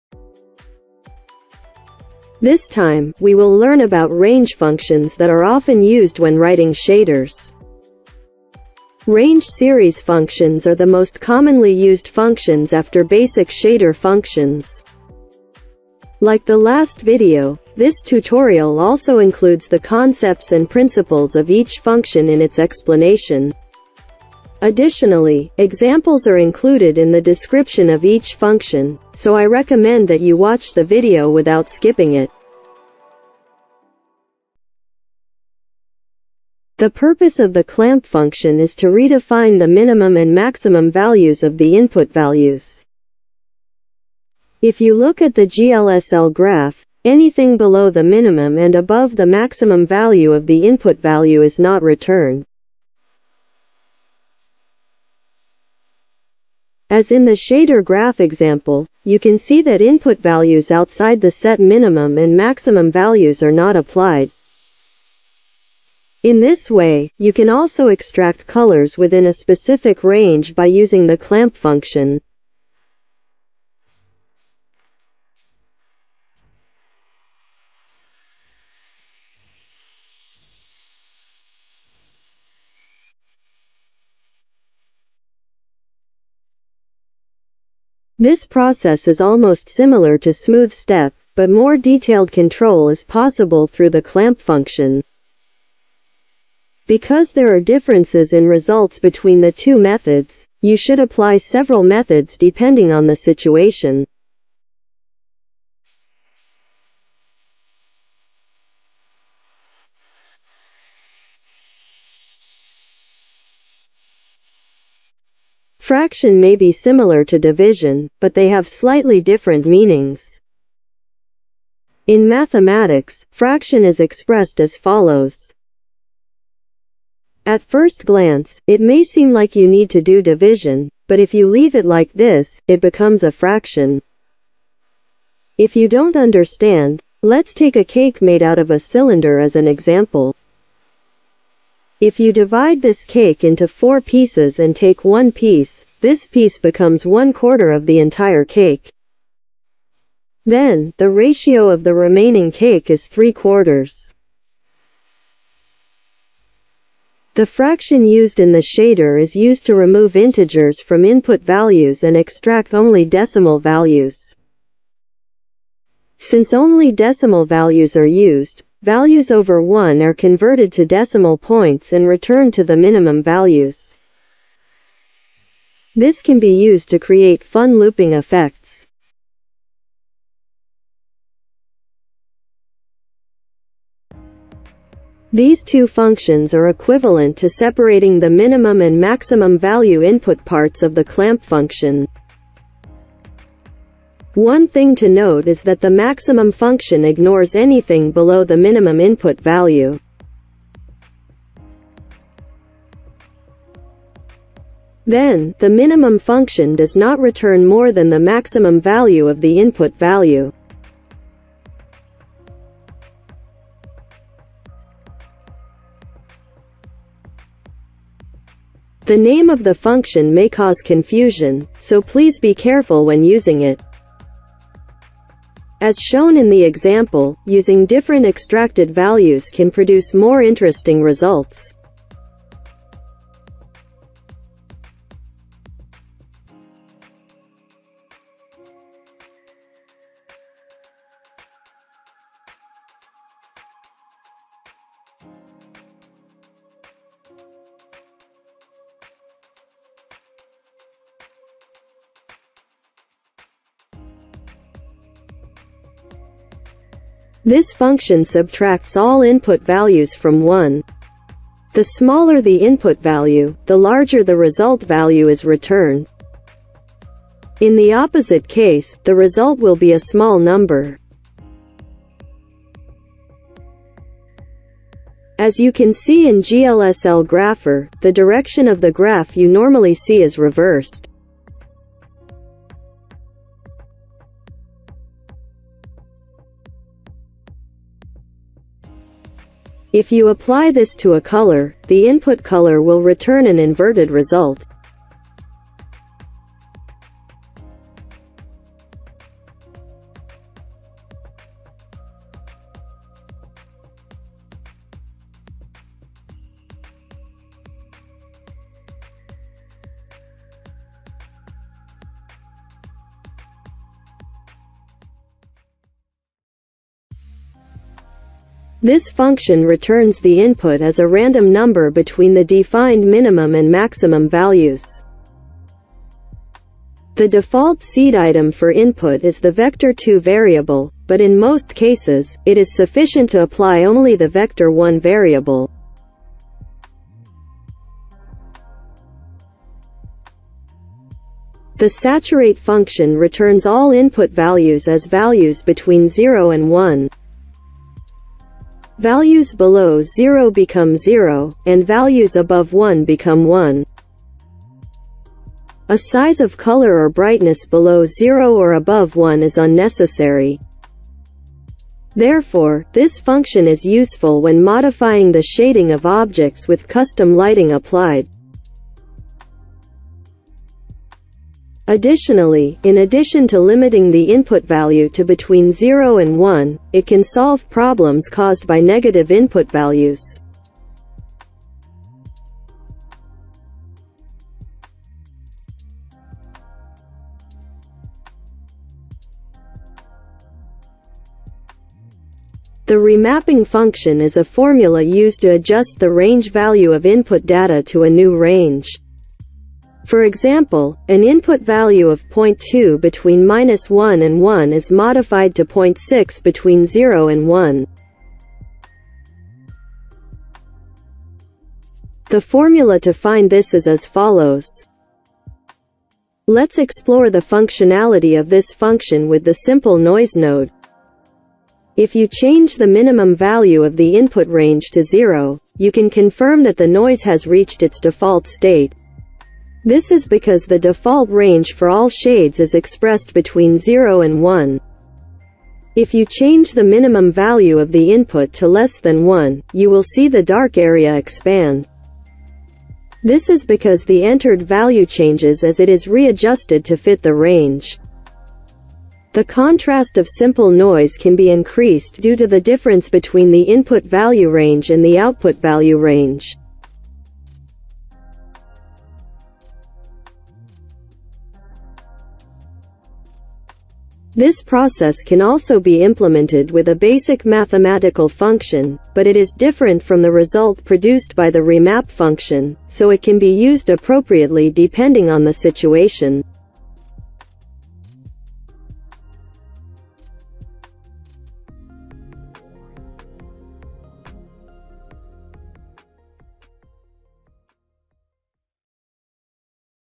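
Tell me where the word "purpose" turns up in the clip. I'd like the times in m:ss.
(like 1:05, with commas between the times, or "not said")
0:36.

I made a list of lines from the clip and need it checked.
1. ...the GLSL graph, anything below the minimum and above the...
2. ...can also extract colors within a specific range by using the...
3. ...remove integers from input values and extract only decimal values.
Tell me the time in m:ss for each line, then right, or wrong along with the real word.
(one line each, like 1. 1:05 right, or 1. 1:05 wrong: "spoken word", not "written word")
1. 0:45 right
2. 1:07 right
3. 2:39 right.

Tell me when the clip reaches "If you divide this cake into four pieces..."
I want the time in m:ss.
2:22.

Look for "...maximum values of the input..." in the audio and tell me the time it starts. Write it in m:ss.
0:40.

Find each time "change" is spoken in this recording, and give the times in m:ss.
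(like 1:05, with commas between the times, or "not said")
7:02, 7:16, 7:25.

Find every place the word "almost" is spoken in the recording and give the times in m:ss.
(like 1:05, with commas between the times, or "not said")
1:29.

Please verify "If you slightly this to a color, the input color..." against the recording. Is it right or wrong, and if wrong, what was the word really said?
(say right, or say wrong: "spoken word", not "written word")
wrong: "apply", not "slightly".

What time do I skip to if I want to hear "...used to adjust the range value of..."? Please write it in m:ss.
6:35.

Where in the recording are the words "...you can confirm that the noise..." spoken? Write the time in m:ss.
7:05.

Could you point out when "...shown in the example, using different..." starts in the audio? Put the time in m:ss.
3:45.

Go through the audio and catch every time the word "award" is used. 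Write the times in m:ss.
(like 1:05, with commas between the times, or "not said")
not said.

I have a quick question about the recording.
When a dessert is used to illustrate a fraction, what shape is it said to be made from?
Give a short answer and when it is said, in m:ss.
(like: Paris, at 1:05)
cylinder, at 2:18.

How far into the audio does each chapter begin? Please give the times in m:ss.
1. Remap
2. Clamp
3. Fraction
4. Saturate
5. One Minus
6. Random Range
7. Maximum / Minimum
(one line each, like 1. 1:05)
1. 6:31
2. 0:35
3. 1:54
4. 5:40
5. 4:15
6. 5:17
7. 3:04.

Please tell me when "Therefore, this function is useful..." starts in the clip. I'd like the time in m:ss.
6:02.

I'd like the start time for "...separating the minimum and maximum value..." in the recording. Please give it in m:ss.
3:07.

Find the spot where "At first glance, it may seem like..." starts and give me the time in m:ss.
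2:07.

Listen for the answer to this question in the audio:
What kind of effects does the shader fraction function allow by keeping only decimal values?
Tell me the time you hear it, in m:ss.
2:57.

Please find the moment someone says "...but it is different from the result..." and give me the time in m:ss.
7:49.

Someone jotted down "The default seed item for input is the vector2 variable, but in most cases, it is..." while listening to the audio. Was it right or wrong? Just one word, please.
right.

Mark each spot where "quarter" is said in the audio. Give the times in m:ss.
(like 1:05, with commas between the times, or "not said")
2:27, 2:33.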